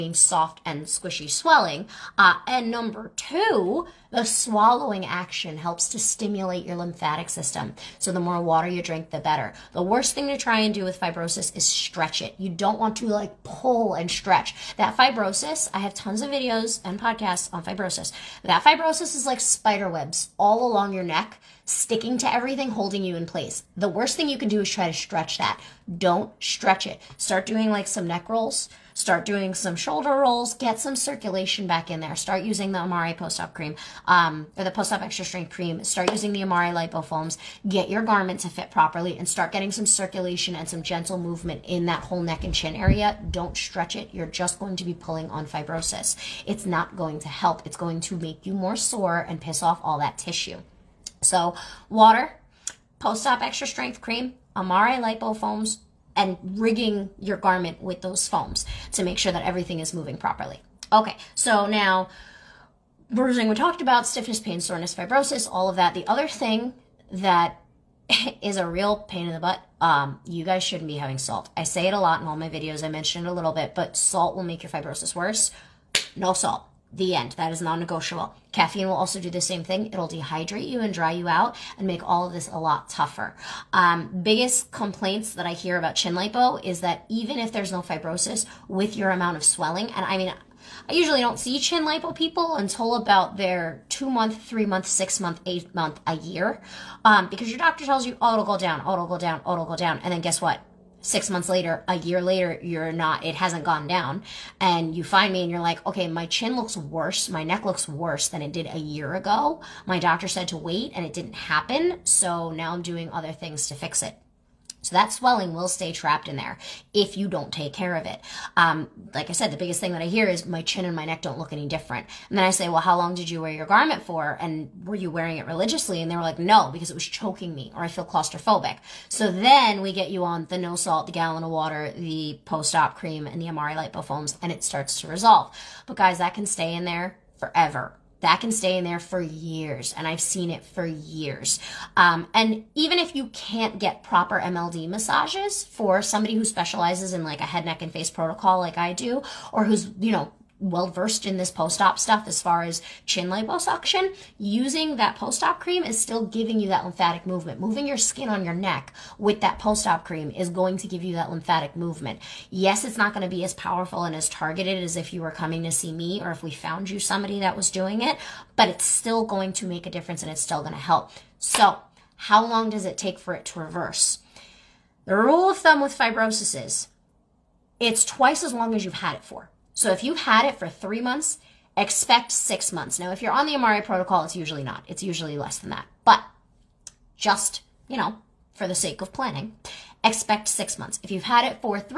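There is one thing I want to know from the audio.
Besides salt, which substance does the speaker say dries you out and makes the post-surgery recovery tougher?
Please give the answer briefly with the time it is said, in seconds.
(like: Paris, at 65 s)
Caffeine, at 78 s.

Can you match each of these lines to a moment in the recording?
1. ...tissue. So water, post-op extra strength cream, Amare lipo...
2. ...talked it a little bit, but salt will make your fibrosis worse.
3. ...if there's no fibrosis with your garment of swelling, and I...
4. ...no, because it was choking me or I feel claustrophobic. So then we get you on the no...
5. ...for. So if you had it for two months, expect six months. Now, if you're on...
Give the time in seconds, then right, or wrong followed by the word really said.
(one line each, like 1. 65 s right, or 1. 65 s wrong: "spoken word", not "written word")
1. 50 s right
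2. 72 s wrong: "mentioned", not "talked"
3. 87 s wrong: "amount", not "garment"
4. 126 s right
5. 179 s wrong: "three", not "two".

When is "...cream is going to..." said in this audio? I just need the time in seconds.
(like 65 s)
160 s.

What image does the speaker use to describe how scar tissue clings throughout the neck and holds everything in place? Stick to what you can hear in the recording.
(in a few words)
spider webs.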